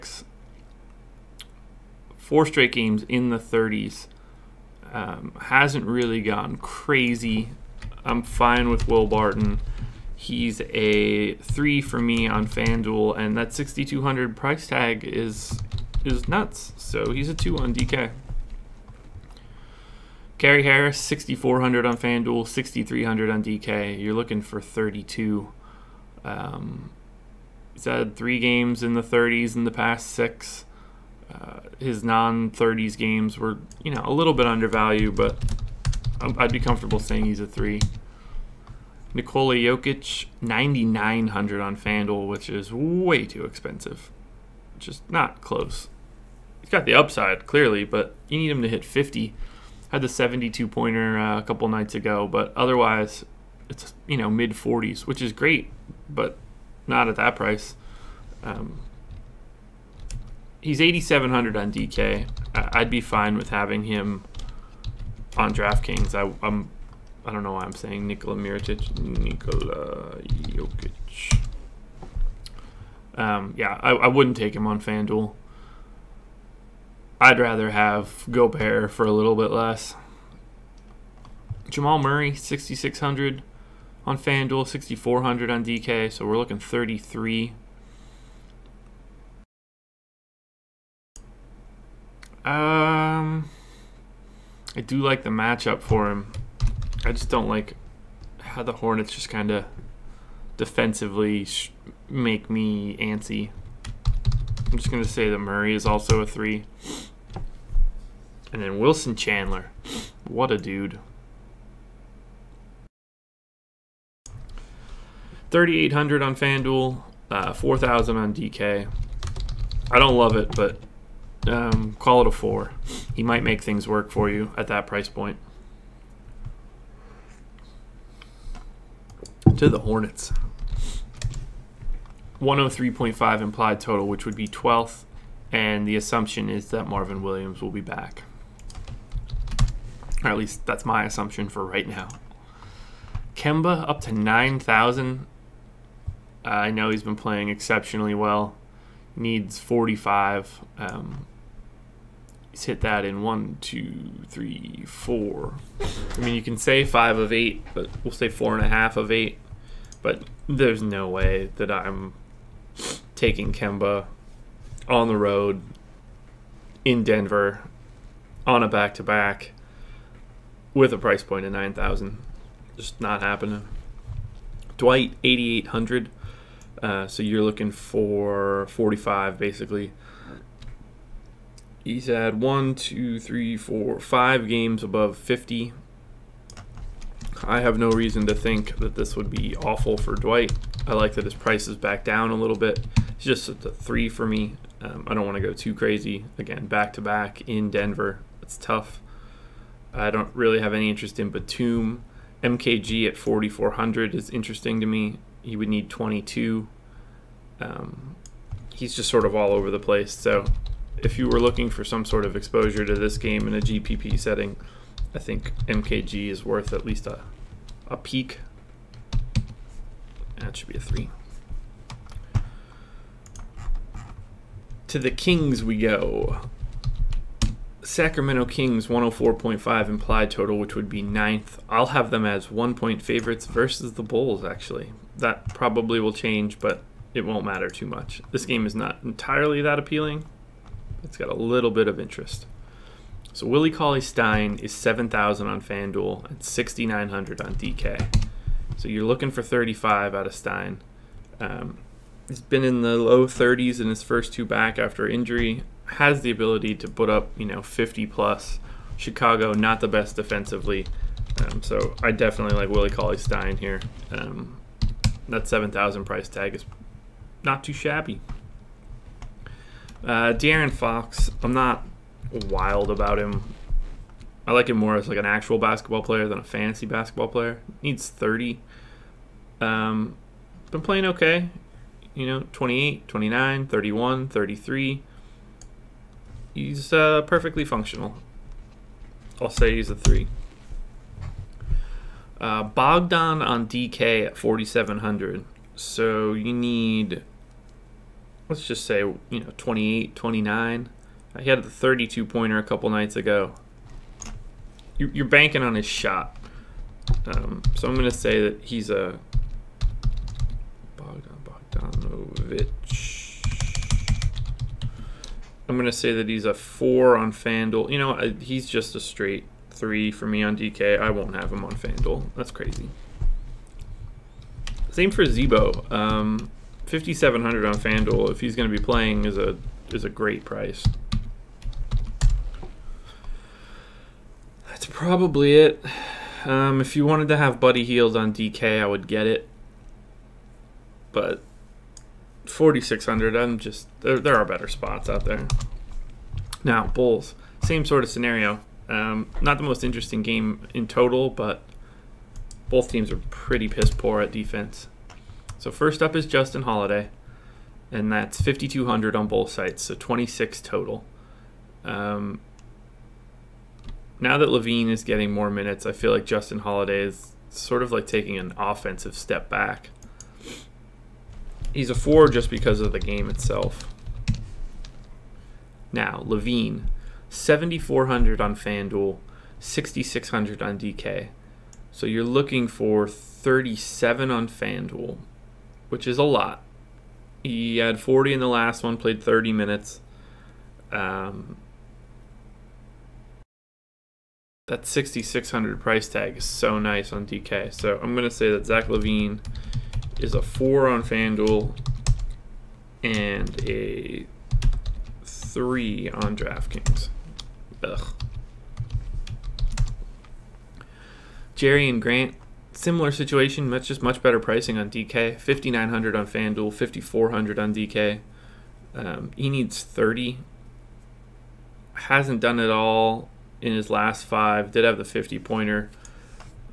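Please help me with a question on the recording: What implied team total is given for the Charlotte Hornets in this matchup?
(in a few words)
103.5.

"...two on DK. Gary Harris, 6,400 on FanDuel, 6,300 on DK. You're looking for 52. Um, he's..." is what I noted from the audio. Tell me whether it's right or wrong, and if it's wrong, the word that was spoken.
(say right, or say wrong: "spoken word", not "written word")
wrong: "32", not "52".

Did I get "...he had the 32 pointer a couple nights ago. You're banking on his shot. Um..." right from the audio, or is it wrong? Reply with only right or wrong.
right.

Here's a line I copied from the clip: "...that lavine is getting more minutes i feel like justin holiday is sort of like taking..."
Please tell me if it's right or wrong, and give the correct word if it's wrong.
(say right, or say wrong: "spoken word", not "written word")
right.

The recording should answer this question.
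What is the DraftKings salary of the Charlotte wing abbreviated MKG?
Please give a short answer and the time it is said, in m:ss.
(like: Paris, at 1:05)
4,400, at 3:23.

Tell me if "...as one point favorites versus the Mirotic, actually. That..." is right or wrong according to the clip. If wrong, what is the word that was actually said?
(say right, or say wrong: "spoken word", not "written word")
wrong: "Bulls", not "Mirotic".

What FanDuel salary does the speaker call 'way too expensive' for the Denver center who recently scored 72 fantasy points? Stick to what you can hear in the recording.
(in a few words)
9,900.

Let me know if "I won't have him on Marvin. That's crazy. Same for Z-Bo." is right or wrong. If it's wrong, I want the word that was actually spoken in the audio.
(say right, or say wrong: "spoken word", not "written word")
wrong: "FanDuel", not "Marvin".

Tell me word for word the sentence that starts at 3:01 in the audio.
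He's had one, two, three, four, five games above 50.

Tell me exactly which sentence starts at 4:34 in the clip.
I like him more as like an actual basketball player than a fantasy basketball player.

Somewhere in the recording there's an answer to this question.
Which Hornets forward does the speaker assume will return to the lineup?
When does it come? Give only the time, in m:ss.
2:16.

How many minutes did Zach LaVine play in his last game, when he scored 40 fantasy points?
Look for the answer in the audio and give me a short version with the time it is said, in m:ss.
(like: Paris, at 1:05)
30, at 6:29.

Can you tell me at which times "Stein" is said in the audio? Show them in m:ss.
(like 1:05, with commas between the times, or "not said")
4:03, 4:10, 4:23.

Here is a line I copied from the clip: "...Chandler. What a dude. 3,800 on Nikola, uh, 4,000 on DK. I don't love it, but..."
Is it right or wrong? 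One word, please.
wrong.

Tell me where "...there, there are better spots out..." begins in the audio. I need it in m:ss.
5:44.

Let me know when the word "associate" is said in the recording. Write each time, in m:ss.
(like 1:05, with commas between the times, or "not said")
not said.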